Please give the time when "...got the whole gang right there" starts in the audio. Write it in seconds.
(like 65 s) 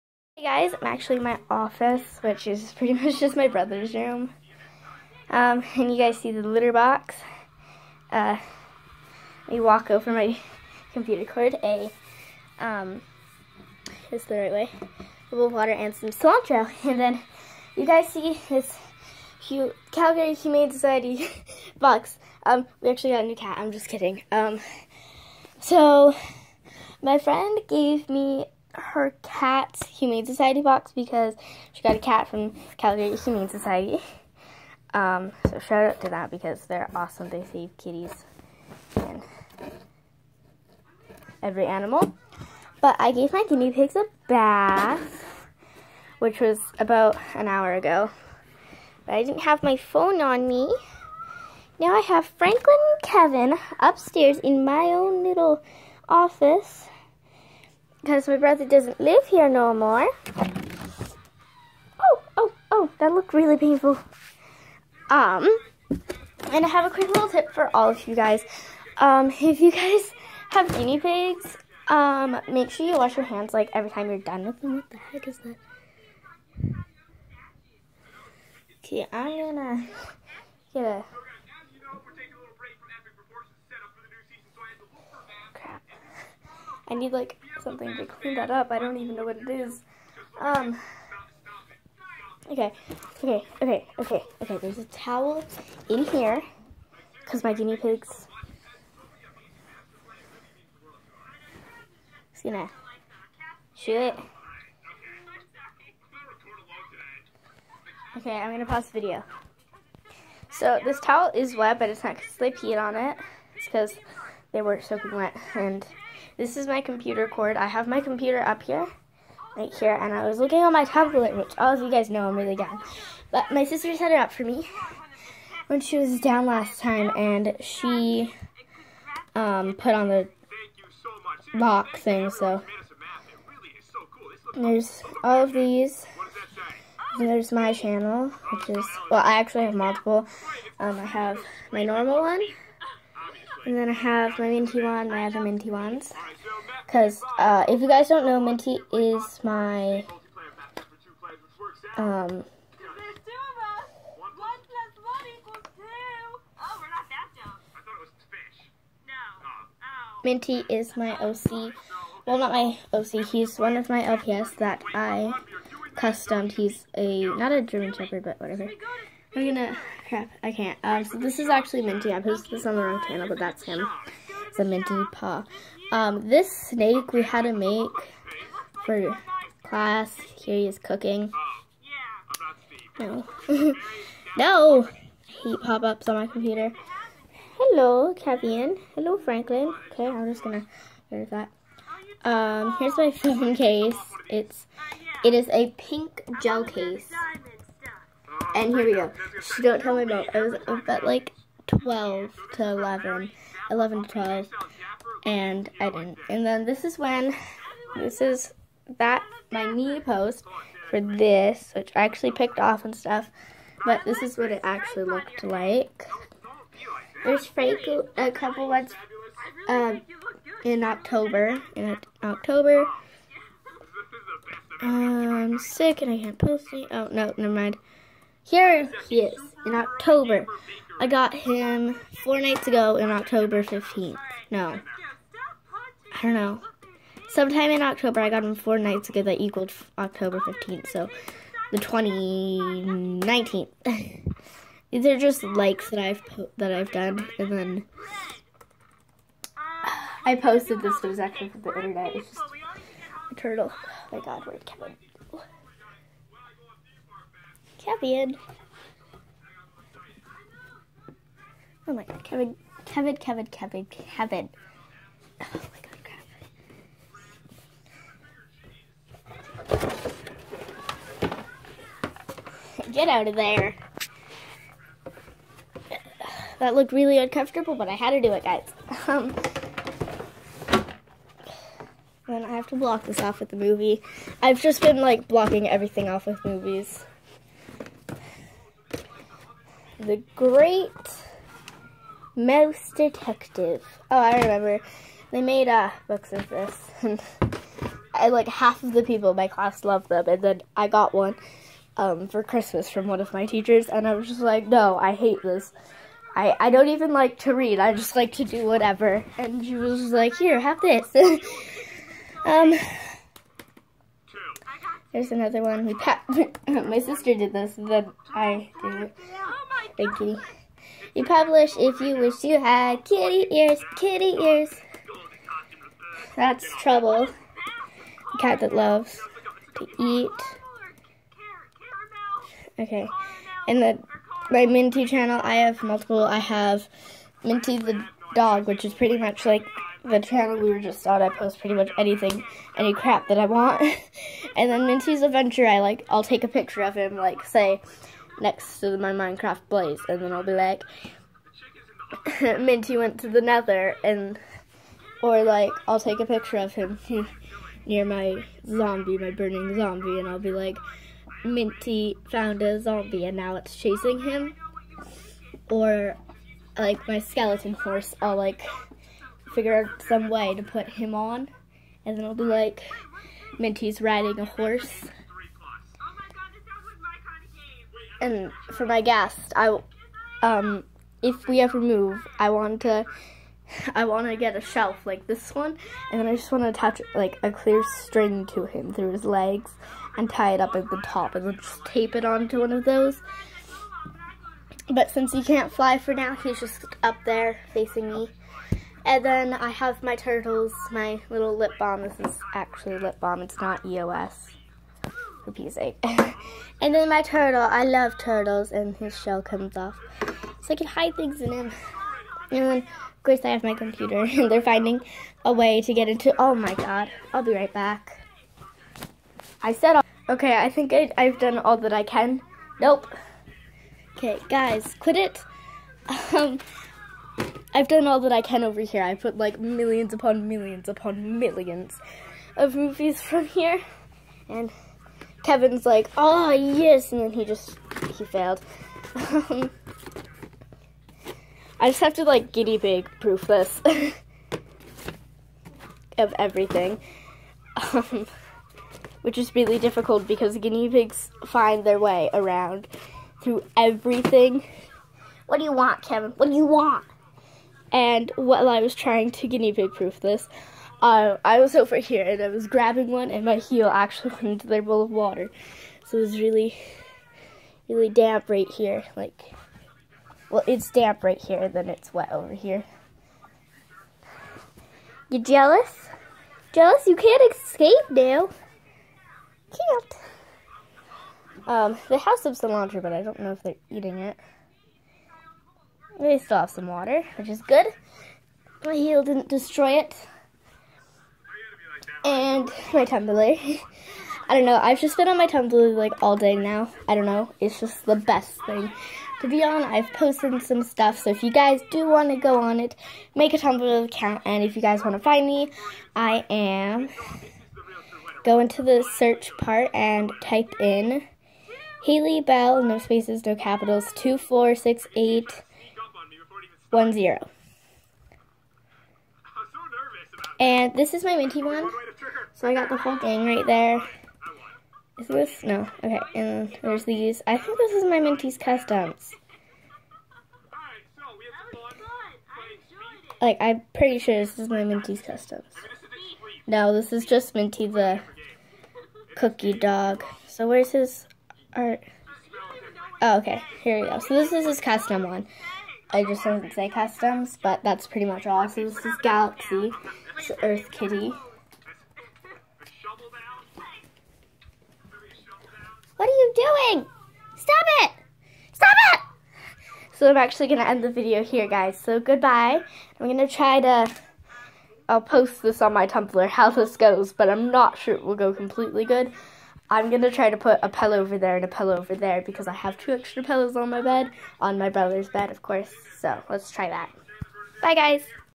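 522 s.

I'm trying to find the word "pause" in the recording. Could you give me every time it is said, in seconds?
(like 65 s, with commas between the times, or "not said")
108 s.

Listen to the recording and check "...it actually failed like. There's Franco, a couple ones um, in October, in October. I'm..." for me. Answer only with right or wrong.
wrong.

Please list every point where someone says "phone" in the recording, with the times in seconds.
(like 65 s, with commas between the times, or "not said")
49 s, 193 s.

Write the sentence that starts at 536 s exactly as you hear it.
No, this is just Minty the cookie dog.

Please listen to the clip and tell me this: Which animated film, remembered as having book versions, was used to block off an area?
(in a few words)
The Great Mouse Detective.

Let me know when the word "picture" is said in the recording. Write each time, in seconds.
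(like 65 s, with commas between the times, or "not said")
346 s, 356 s.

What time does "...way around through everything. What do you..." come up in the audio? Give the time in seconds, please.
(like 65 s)
451 s.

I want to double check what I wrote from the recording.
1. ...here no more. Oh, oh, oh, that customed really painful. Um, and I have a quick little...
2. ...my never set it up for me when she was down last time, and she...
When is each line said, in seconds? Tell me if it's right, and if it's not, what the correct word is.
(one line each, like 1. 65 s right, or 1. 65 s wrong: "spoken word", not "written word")
1. 59 s wrong: "looked", not "customed"
2. 123 s wrong: "sister", not "never".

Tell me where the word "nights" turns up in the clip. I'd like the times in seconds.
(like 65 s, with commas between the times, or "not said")
232 s, 238 s.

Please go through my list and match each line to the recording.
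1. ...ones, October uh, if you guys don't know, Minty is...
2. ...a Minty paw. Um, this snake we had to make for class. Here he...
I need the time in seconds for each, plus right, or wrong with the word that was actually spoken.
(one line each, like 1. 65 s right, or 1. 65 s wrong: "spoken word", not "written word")
1. 145 s wrong: "Because", not "October"
2. 174 s right.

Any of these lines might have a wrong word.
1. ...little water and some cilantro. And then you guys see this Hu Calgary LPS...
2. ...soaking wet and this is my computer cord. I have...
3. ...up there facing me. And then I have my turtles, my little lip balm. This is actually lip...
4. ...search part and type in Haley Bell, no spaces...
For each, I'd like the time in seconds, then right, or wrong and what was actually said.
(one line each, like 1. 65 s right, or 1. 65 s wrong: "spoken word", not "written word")
1. 15 s wrong: "Humane", not "LPS"
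2. 114 s right
3. 397 s right
4. 509 s right.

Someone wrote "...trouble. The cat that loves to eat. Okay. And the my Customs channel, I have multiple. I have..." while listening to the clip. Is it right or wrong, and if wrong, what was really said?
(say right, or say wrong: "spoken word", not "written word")
wrong: "Minty", not "Customs".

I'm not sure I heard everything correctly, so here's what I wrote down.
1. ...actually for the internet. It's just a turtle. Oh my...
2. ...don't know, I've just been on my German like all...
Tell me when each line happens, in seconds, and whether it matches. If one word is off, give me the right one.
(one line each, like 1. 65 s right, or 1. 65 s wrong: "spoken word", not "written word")
1. 251 s right
2. 494 s wrong: "Tumblr", not "German".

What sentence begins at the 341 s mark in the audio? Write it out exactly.
I post pretty much anything, any crap that I want.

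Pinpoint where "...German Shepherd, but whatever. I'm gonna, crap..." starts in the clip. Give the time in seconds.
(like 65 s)
167 s.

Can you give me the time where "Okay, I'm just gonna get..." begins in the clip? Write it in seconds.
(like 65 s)
189 s.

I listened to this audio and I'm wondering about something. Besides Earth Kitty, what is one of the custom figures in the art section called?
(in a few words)
Galaxy.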